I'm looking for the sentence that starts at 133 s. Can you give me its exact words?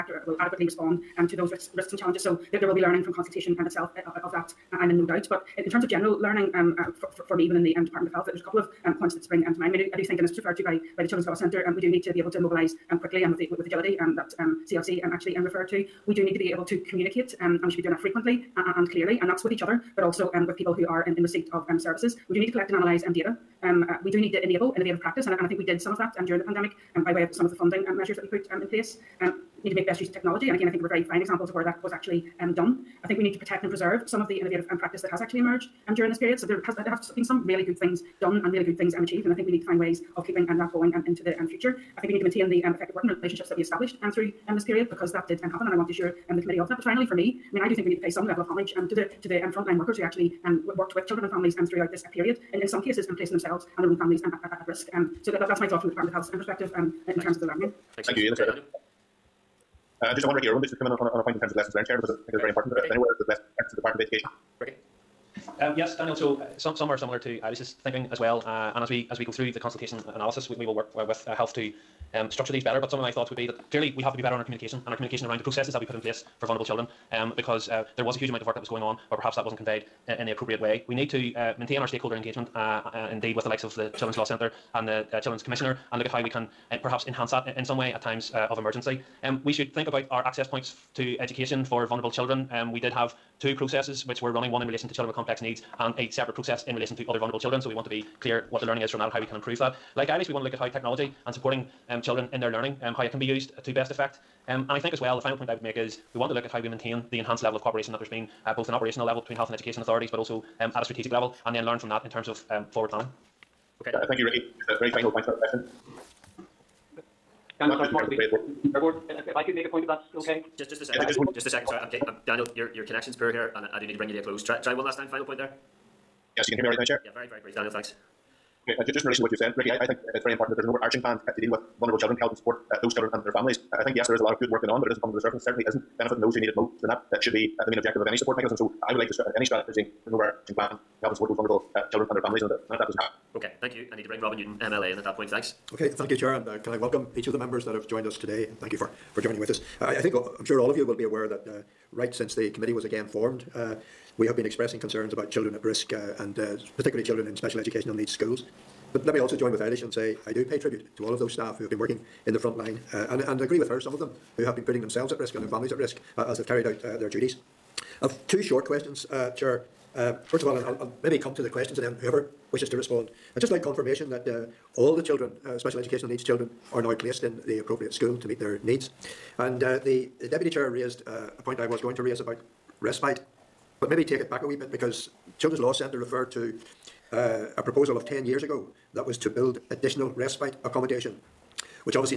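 I think, yes, there is a lot of good work going on, but it isn't coming to the surface.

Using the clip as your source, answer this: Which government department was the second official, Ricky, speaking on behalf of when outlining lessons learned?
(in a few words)
Department of Education.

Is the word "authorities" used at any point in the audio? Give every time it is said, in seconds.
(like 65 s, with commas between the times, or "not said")
109 s.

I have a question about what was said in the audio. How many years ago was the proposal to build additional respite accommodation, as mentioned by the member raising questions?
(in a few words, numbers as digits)
10 years.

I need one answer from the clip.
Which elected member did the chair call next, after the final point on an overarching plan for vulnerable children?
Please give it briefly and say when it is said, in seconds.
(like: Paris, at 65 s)
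Robin Newton, at 144 s.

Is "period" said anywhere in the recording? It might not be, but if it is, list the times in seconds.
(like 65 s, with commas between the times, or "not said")
36 s, 44 s, 52 s.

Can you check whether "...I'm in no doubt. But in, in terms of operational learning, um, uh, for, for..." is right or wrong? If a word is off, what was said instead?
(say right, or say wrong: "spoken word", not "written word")
wrong: "general", not "operational".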